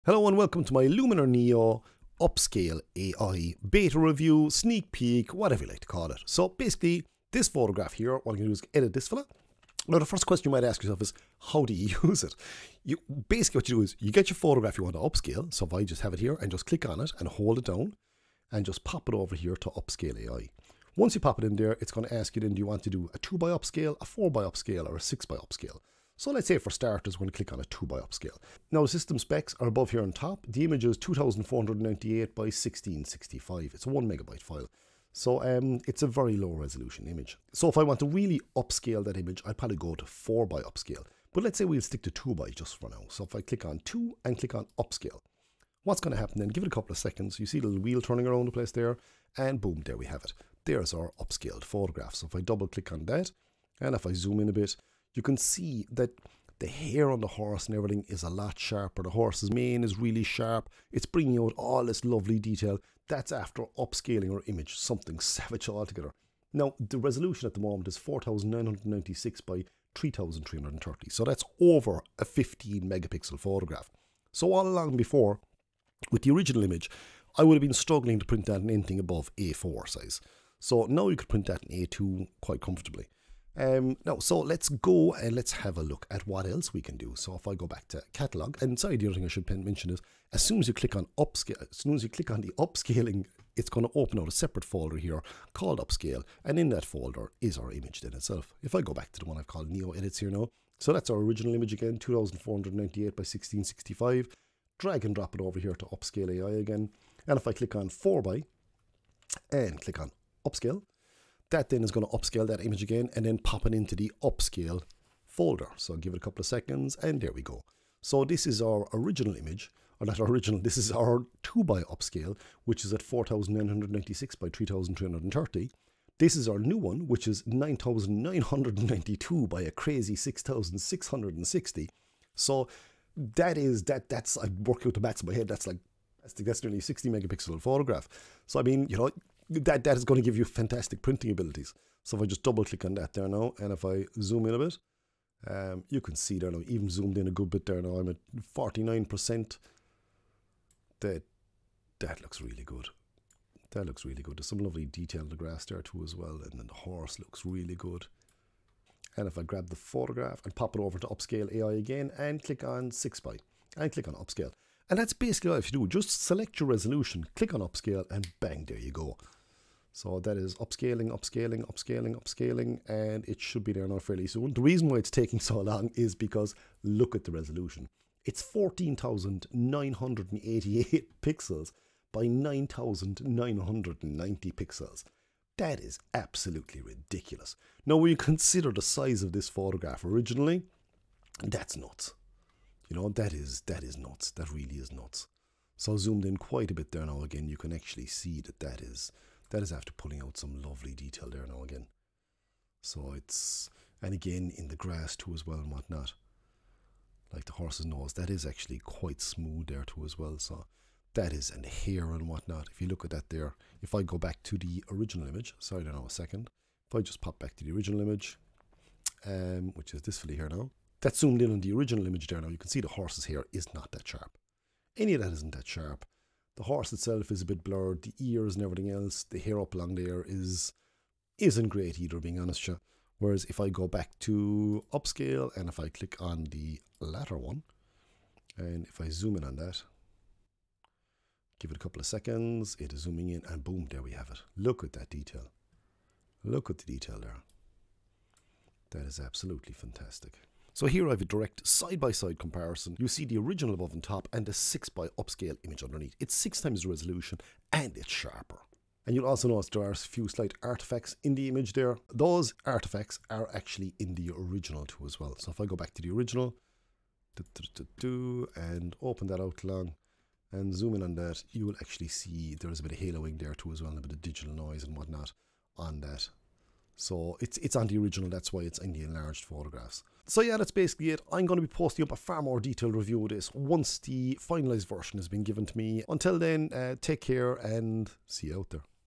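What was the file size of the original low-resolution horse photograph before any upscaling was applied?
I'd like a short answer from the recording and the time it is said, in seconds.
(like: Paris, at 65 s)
1 megabyte, at 33 s.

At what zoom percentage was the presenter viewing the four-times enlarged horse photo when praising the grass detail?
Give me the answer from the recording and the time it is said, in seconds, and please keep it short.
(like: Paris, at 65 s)
49%, at 148 s.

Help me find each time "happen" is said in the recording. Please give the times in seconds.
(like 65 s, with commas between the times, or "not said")
46 s.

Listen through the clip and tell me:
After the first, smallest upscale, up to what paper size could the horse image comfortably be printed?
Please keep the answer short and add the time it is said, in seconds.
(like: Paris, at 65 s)
A2, at 81 s.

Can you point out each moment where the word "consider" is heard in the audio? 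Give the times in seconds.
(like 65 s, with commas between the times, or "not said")
188 s.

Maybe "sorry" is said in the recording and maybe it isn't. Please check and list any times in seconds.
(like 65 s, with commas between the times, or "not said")
88 s, 215 s.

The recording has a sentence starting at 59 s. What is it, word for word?
The horse's mane is really sharp.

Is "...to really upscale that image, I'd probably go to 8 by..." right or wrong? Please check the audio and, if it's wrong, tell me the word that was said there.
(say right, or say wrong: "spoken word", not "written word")
wrong: "4", not "8".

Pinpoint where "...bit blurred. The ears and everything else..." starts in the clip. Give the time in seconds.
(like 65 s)
227 s.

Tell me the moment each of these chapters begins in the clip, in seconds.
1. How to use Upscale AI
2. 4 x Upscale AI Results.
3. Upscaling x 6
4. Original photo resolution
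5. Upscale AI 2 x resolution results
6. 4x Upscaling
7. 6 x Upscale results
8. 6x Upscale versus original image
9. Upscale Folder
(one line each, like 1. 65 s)
1. 14 s
2. 144 s
3. 160 s
4. 29 s
5. 50 s
6. 105 s
7. 177 s
8. 208 s
9. 89 s.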